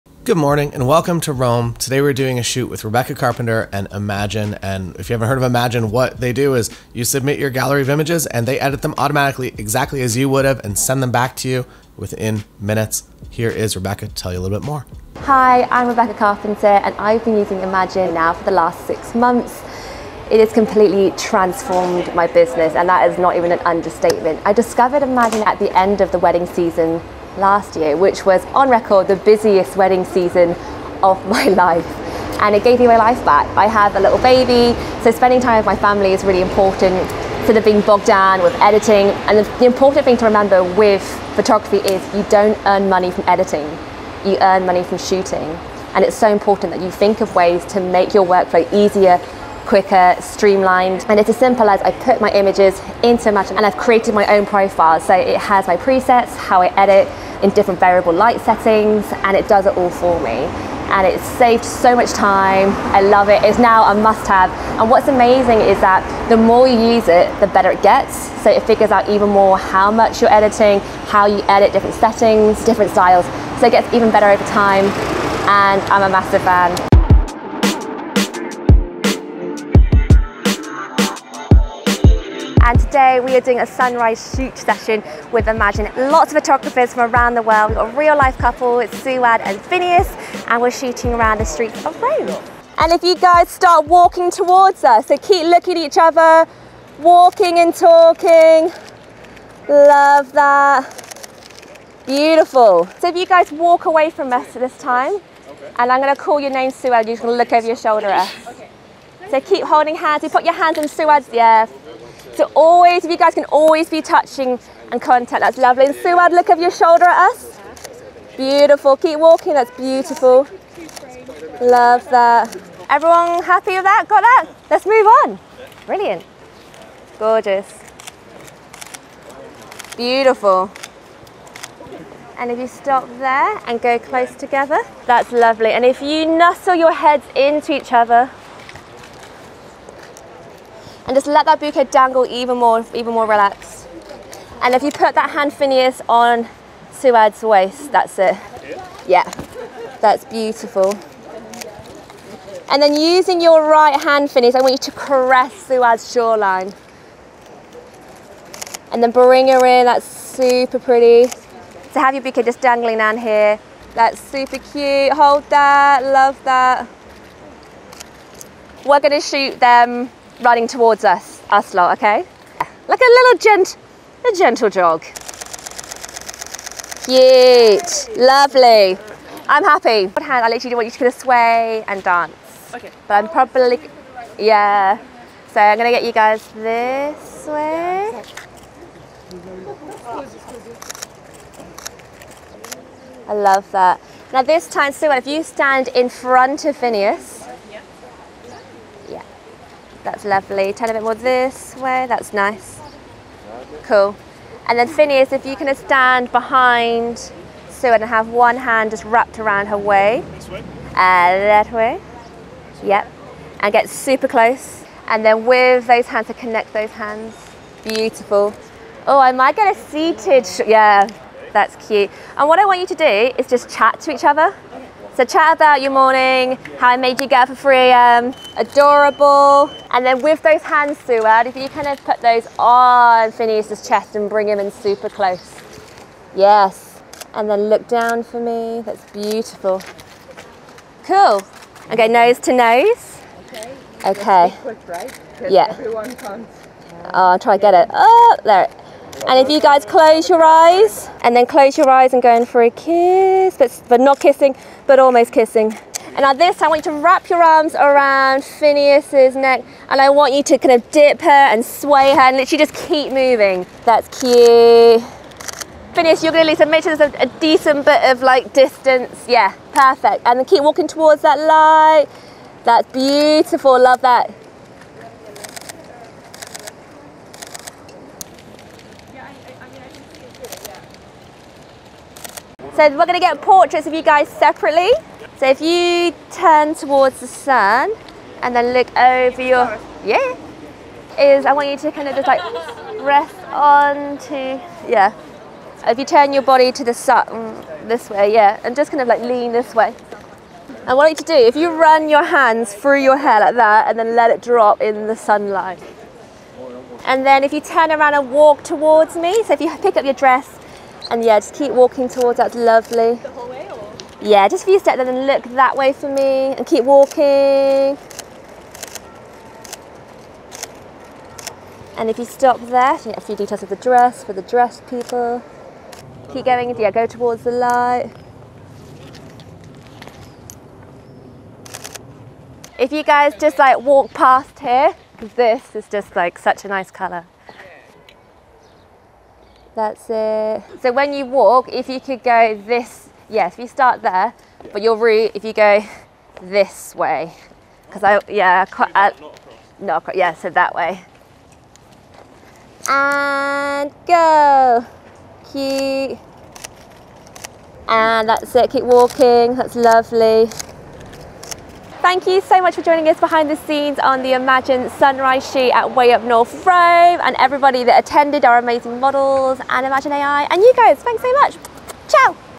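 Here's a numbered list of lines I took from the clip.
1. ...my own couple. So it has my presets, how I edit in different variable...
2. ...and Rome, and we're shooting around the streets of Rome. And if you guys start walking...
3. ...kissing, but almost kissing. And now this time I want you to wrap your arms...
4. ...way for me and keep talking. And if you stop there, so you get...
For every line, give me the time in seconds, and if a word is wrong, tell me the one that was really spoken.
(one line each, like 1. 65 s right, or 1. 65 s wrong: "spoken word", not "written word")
1. 54 s wrong: "profile", not "couple"
2. 89 s wrong: "Phineas", not "Rome"
3. 254 s right
4. 315 s wrong: "walking", not "talking".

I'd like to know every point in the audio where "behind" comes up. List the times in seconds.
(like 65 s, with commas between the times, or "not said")
206 s, 363 s.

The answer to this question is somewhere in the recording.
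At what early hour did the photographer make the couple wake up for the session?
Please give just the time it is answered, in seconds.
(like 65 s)
227 s.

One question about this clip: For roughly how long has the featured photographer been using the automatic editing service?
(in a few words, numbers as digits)
six months.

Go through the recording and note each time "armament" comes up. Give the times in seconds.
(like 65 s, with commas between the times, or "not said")
not said.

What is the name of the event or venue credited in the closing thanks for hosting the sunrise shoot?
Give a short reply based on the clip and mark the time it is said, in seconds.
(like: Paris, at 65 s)
Way Up North Rome, at 365 s.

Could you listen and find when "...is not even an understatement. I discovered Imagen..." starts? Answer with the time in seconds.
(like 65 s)
23 s.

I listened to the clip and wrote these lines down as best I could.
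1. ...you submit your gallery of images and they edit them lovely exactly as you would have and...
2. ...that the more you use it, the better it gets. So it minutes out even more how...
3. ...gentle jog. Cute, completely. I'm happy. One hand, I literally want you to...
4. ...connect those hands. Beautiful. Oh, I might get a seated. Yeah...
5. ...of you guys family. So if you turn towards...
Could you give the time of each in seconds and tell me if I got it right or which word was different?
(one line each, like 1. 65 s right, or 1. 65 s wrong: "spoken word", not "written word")
1. 6 s wrong: "automatically", not "lovely"
2. 65 s wrong: "figures", not "minutes"
3. 174 s wrong: "lovely", not "completely"
4. 216 s right
5. 283 s wrong: "separately", not "family".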